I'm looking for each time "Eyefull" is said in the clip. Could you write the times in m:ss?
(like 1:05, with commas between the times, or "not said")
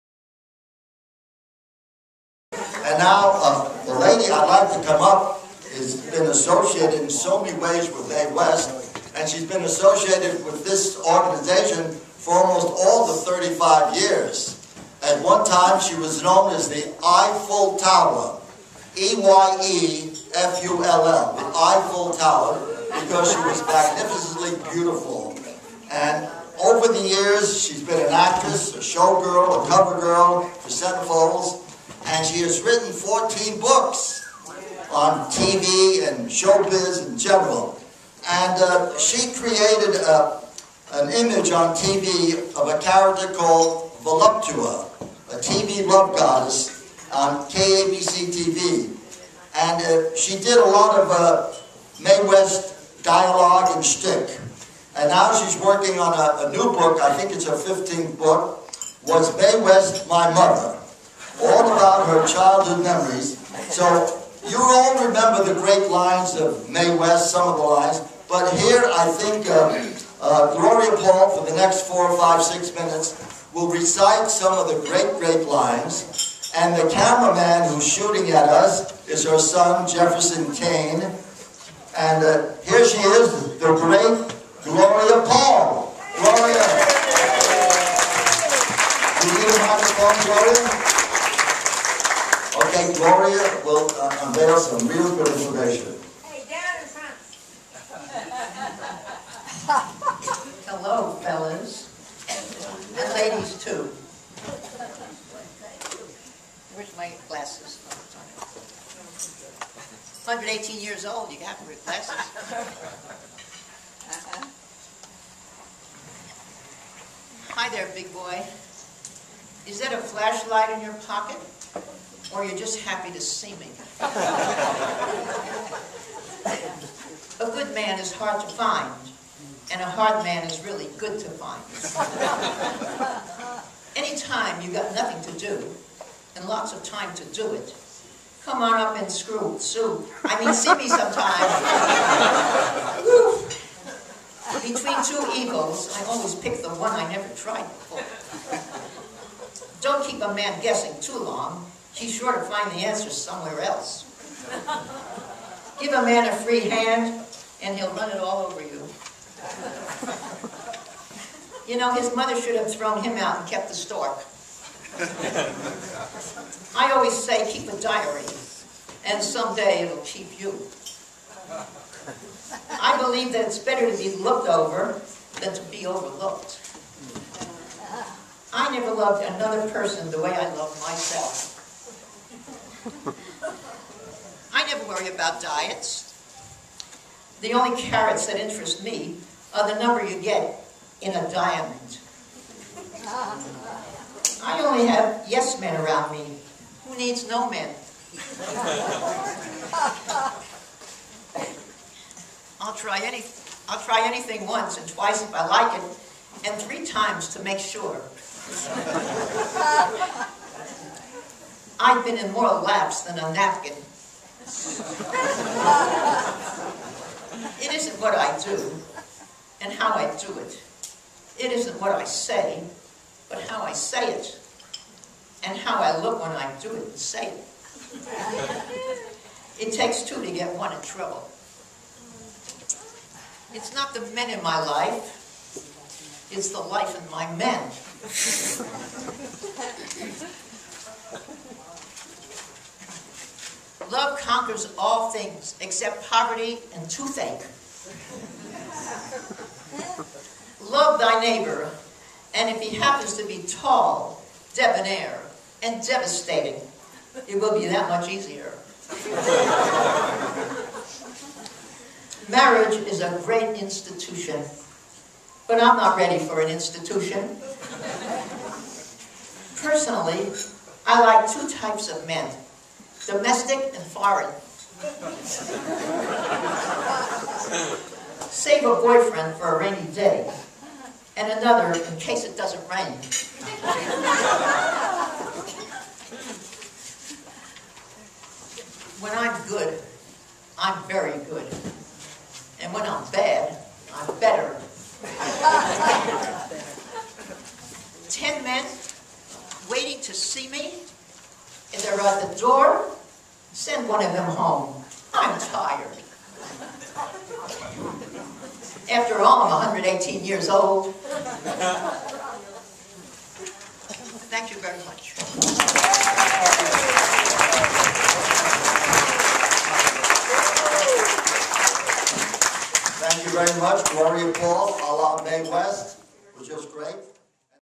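0:16, 0:21.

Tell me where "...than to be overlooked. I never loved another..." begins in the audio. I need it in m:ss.
2:55.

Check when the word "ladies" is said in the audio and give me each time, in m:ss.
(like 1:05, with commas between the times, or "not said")
1:43.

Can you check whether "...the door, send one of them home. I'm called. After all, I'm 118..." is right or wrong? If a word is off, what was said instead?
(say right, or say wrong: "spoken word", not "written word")
wrong: "tired", not "called".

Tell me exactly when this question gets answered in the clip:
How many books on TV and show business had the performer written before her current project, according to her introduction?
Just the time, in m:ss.
0:32.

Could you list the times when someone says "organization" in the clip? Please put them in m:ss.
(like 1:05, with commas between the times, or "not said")
0:11.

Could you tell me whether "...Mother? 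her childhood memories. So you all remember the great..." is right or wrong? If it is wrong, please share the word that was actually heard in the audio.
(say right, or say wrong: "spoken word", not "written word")
right.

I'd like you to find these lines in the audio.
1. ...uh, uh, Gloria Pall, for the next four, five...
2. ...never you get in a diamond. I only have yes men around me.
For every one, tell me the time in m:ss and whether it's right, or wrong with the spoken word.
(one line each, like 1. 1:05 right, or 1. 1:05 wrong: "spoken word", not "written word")
1. 1:09 right
2. 3:09 wrong: "number", not "never".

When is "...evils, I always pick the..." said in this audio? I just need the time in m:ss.
2:25.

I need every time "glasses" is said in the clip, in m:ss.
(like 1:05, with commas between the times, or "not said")
1:47, 1:51.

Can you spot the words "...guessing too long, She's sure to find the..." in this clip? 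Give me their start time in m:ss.
2:30.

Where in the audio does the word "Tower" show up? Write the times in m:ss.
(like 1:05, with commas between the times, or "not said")
0:17, 0:22.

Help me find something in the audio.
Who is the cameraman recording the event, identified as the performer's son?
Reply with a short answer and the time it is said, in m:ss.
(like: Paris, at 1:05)
Jefferson Kane, at 1:19.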